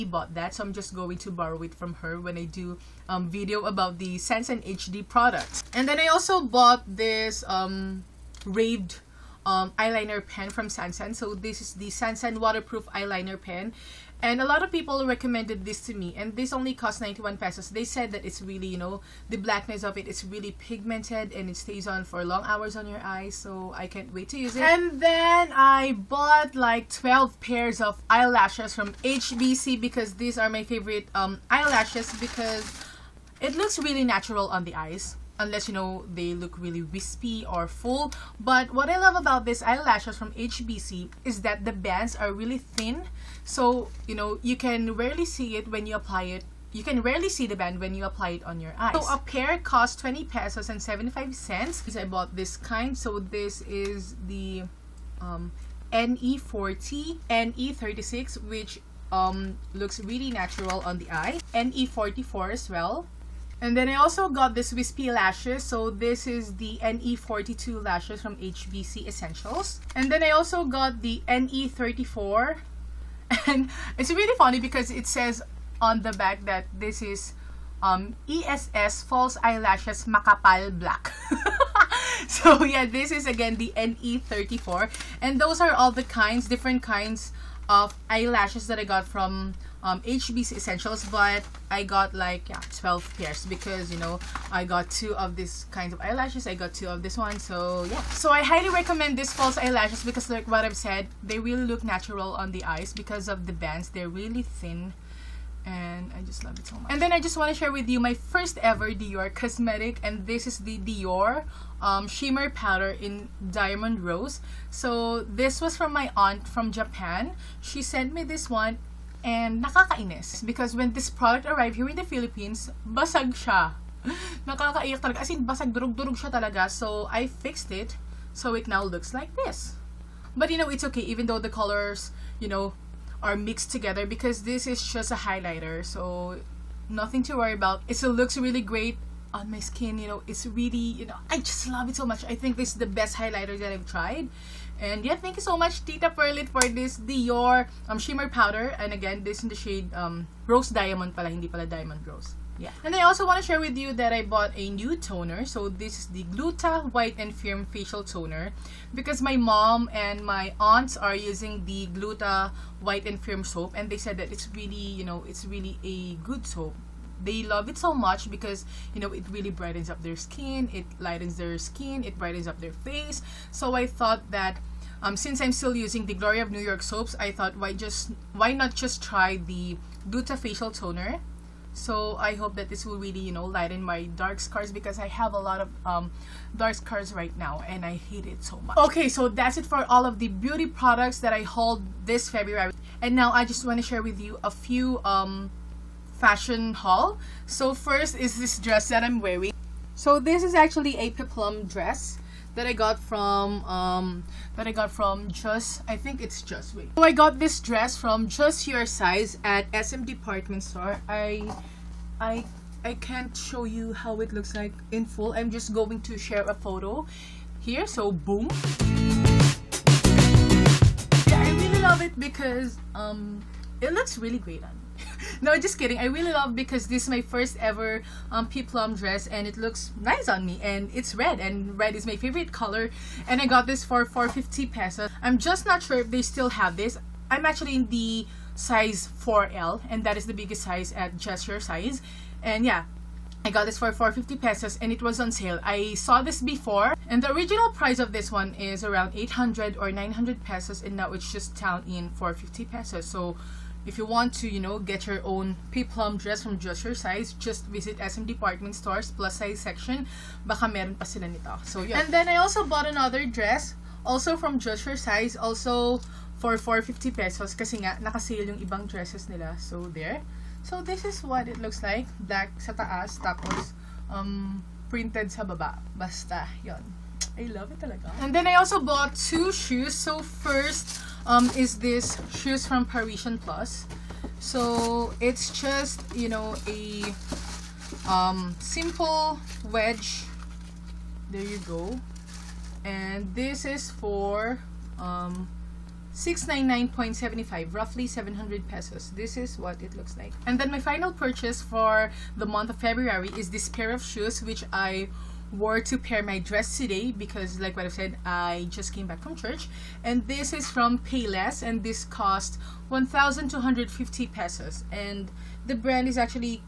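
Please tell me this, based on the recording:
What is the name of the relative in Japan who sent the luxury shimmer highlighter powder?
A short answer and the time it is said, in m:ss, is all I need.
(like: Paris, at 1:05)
Tita Perlit, at 2:25.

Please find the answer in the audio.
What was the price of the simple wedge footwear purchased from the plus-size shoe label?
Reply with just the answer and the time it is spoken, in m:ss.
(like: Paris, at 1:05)
699.75 pesos, at 4:56.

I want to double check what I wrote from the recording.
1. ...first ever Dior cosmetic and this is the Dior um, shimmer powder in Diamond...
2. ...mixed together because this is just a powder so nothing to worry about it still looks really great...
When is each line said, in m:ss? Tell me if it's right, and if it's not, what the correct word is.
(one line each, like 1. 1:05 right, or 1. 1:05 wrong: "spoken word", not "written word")
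1. 1:48 right
2. 2:13 wrong: "highlighter", not "powder".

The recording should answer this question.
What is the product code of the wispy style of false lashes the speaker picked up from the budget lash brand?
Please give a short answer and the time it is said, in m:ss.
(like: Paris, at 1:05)
NE42, at 1:06.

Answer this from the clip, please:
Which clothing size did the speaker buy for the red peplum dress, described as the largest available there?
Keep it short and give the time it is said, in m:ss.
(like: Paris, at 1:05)
4L, at 3:58.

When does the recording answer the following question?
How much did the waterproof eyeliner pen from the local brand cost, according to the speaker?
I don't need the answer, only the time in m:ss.
0:17.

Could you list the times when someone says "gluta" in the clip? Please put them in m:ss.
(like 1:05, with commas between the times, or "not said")
2:36, 2:41, 3:00.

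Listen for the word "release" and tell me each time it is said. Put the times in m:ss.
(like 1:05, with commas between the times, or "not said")
not said.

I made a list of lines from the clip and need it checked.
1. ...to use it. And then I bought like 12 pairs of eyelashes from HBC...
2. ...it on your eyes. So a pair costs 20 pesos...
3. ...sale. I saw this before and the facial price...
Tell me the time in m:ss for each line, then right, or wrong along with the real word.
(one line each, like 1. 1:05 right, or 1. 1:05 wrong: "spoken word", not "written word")
1. 0:24 right
2. 0:48 right
3. 4:05 wrong: "original", not "facial".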